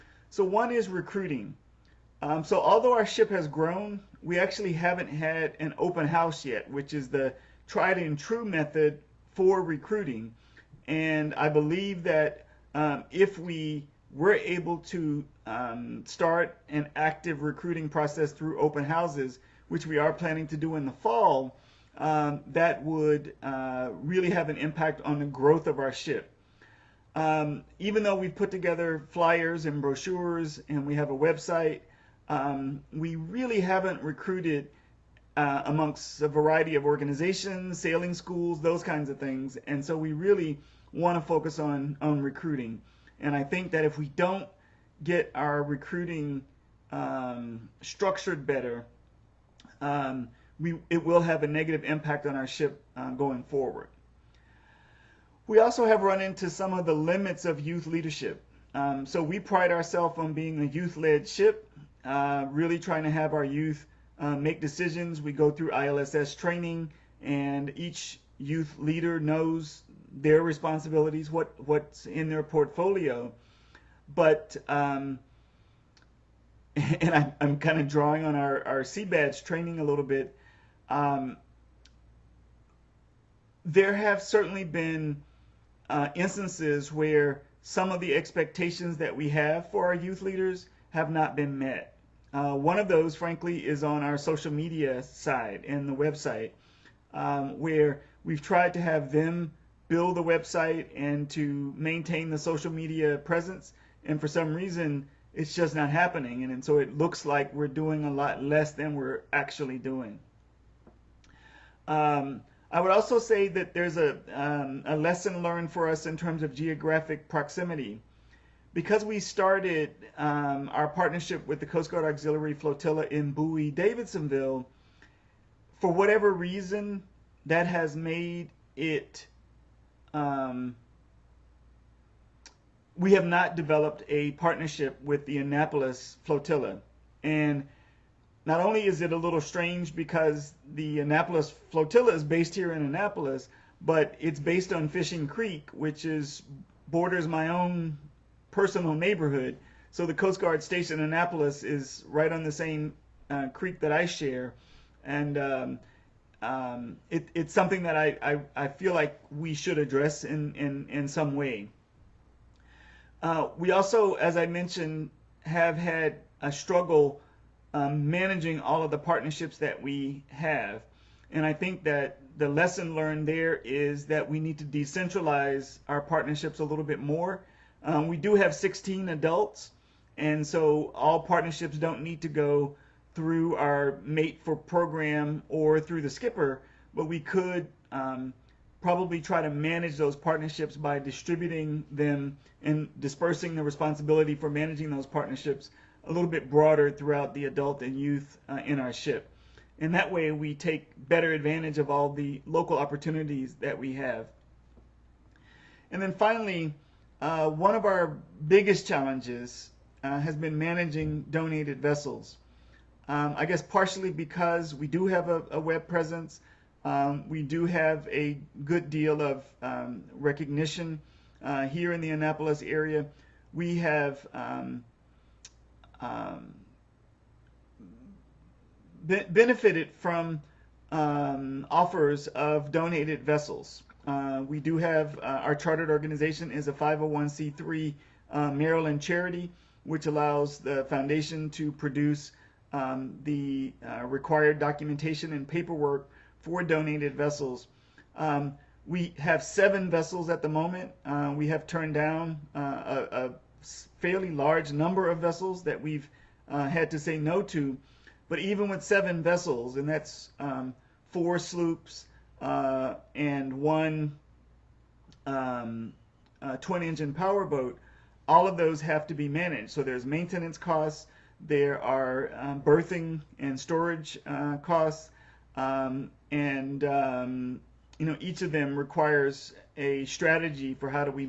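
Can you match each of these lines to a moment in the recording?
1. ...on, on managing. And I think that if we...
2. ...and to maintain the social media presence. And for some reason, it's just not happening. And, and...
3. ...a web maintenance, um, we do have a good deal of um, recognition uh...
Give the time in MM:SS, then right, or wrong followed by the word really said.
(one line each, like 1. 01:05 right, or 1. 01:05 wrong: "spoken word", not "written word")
1. 00:41 wrong: "recruiting", not "managing"
2. 01:40 right
3. 03:35 wrong: "presence", not "maintenance".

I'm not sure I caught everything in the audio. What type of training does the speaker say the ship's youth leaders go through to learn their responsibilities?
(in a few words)
ILSS training.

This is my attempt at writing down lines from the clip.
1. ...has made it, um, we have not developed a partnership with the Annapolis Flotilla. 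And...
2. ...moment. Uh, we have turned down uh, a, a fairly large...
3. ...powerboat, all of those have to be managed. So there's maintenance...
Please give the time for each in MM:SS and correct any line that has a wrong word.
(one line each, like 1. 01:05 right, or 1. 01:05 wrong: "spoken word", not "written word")
1. 02:07 right
2. 04:10 right
3. 04:27 right.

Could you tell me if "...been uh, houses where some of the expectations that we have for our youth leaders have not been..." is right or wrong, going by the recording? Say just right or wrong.
wrong.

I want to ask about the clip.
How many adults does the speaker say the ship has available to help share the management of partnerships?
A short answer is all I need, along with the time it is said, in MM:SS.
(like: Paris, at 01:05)
16, at 02:58.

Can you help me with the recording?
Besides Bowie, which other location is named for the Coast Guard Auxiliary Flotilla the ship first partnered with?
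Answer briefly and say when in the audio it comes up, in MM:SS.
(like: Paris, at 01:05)
Davidsonville, at 02:03.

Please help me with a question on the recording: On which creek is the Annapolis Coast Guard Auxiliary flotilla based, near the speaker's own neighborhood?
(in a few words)
Fishing Creek.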